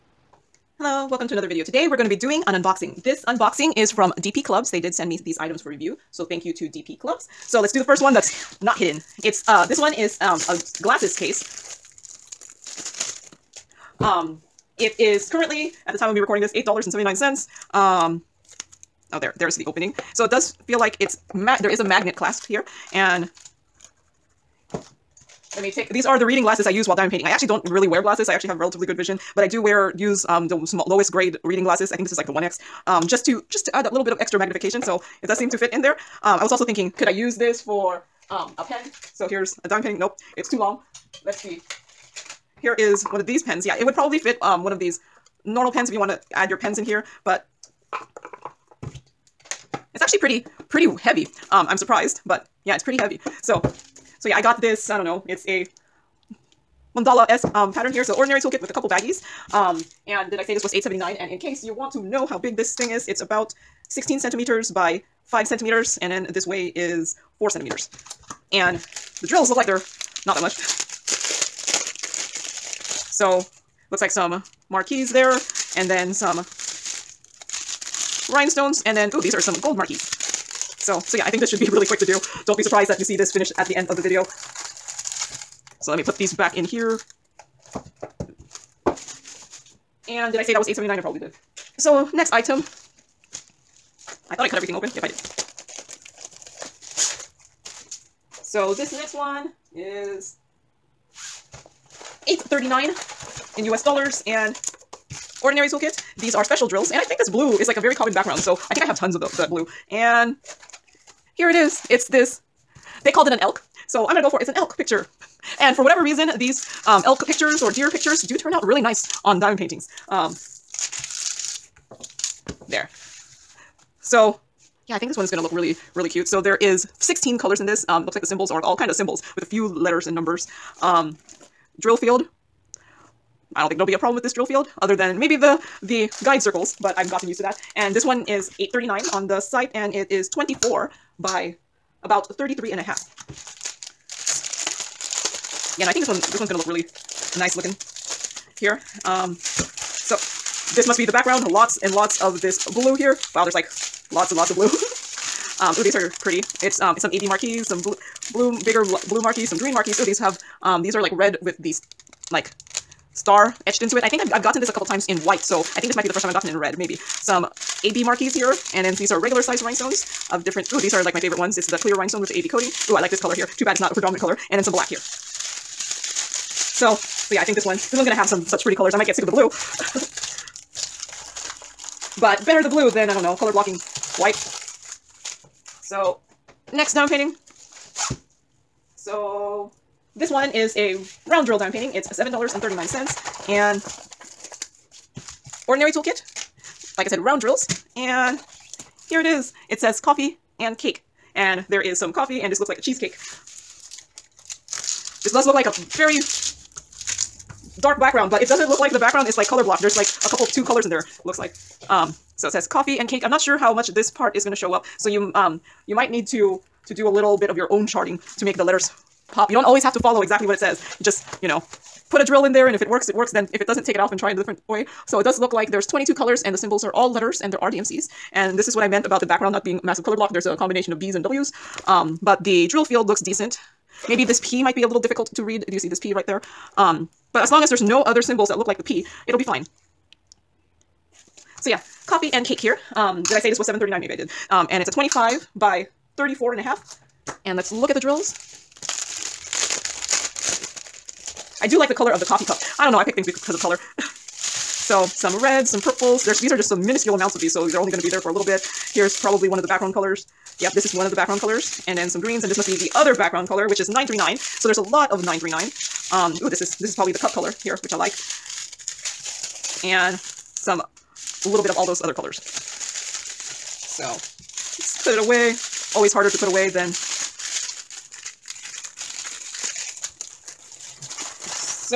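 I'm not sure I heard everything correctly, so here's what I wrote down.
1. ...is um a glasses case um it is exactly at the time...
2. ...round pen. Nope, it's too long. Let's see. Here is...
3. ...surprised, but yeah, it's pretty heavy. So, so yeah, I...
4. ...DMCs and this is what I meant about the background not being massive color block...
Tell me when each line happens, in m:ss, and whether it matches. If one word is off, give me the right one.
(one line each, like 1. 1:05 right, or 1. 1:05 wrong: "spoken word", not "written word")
1. 0:09 wrong: "currently", not "exactly"
2. 0:39 wrong: "diamond", not "round"
3. 0:51 right
4. 3:47 right.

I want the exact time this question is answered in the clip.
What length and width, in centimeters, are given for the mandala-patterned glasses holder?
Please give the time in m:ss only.
1:03.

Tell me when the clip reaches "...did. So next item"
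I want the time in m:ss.
1:31.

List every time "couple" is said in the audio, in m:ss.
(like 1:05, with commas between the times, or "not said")
0:58, 2:44, 3:30.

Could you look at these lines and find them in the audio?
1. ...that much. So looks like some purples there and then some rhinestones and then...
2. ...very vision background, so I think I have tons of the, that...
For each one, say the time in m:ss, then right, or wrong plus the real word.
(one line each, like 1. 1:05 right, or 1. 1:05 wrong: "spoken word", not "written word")
1. 1:10 wrong: "marquees", not "purples"
2. 1:47 wrong: "common", not "vision".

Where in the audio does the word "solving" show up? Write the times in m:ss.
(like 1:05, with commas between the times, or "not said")
not said.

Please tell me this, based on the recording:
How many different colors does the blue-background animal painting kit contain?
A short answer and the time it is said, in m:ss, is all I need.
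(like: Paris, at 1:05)
16, at 2:07.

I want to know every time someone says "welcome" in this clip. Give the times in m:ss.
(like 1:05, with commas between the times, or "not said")
0:01.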